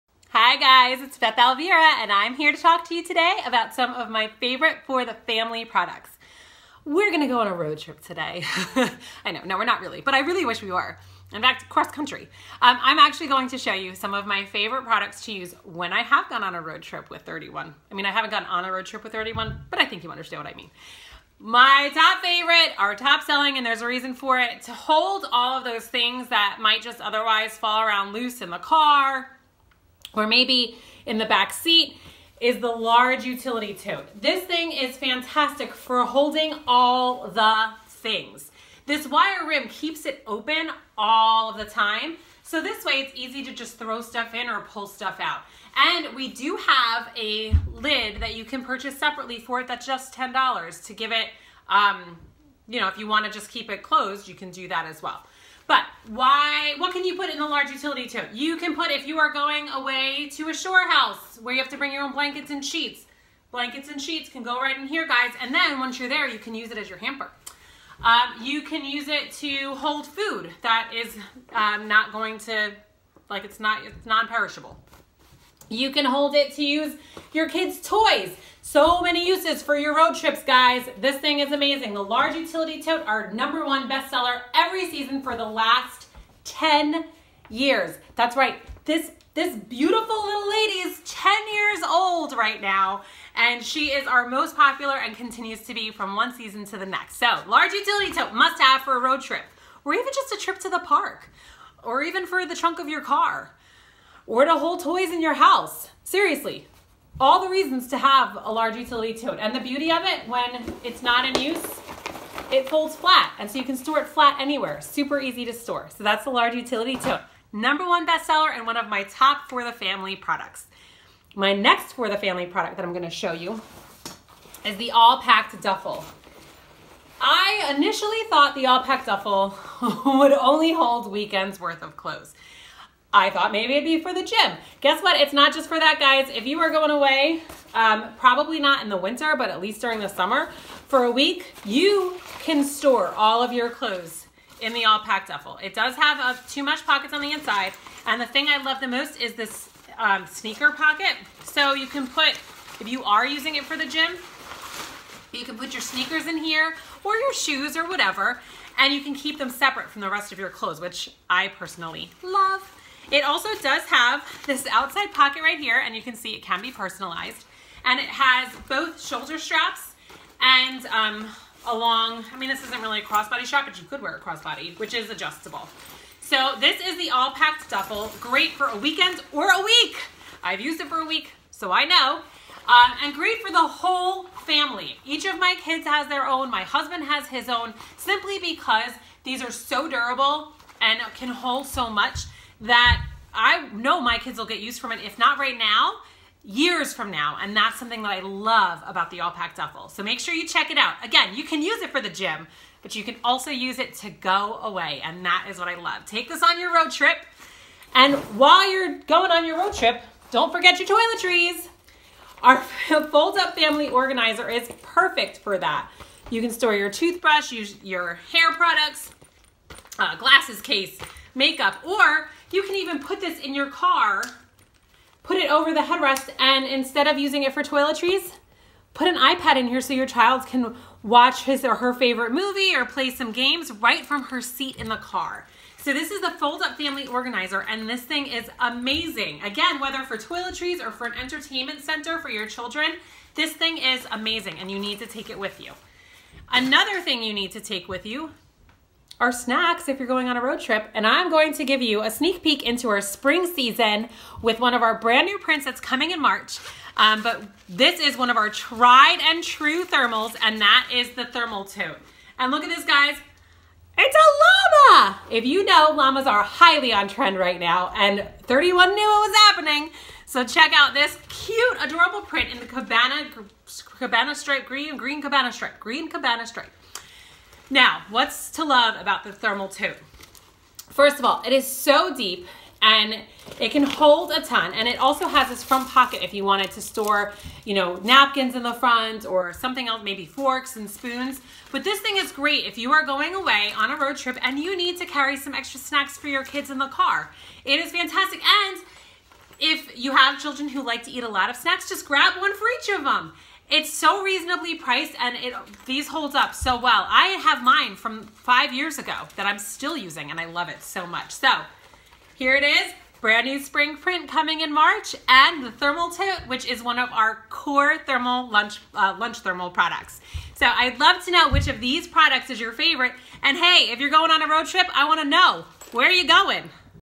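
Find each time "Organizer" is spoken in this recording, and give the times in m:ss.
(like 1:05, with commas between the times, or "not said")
3:33, 3:57.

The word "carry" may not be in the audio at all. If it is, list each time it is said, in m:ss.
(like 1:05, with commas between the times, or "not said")
4:55.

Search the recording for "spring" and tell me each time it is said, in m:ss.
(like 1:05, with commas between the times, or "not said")
4:13, 5:13.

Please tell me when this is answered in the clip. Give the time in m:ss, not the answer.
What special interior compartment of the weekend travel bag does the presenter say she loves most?
2:30.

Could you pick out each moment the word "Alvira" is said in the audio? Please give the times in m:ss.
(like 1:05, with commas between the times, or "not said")
0:01.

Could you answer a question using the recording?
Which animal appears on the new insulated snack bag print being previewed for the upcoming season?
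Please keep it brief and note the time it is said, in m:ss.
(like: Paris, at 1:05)
llama, at 4:24.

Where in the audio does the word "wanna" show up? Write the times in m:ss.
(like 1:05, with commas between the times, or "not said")
0:53, 5:25.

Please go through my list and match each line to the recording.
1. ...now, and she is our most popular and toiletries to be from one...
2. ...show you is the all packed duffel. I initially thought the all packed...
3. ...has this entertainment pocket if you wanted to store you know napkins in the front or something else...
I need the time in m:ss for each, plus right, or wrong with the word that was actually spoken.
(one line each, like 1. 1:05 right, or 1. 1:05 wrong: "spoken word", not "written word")
1. 1:32 wrong: "continues", not "toiletries"
2. 2:03 right
3. 4:45 wrong: "front", not "entertainment".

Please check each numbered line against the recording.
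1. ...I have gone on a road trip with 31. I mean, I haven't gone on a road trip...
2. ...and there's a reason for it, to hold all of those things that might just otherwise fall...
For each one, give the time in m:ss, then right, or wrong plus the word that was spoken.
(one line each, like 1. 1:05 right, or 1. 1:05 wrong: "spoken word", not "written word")
1. 0:15 right
2. 0:23 right.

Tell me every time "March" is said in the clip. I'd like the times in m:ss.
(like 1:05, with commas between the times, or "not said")
4:16, 5:14.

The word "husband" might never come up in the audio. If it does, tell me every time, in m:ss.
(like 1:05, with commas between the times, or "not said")
3:06.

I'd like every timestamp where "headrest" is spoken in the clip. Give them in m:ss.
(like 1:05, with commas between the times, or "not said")
3:45.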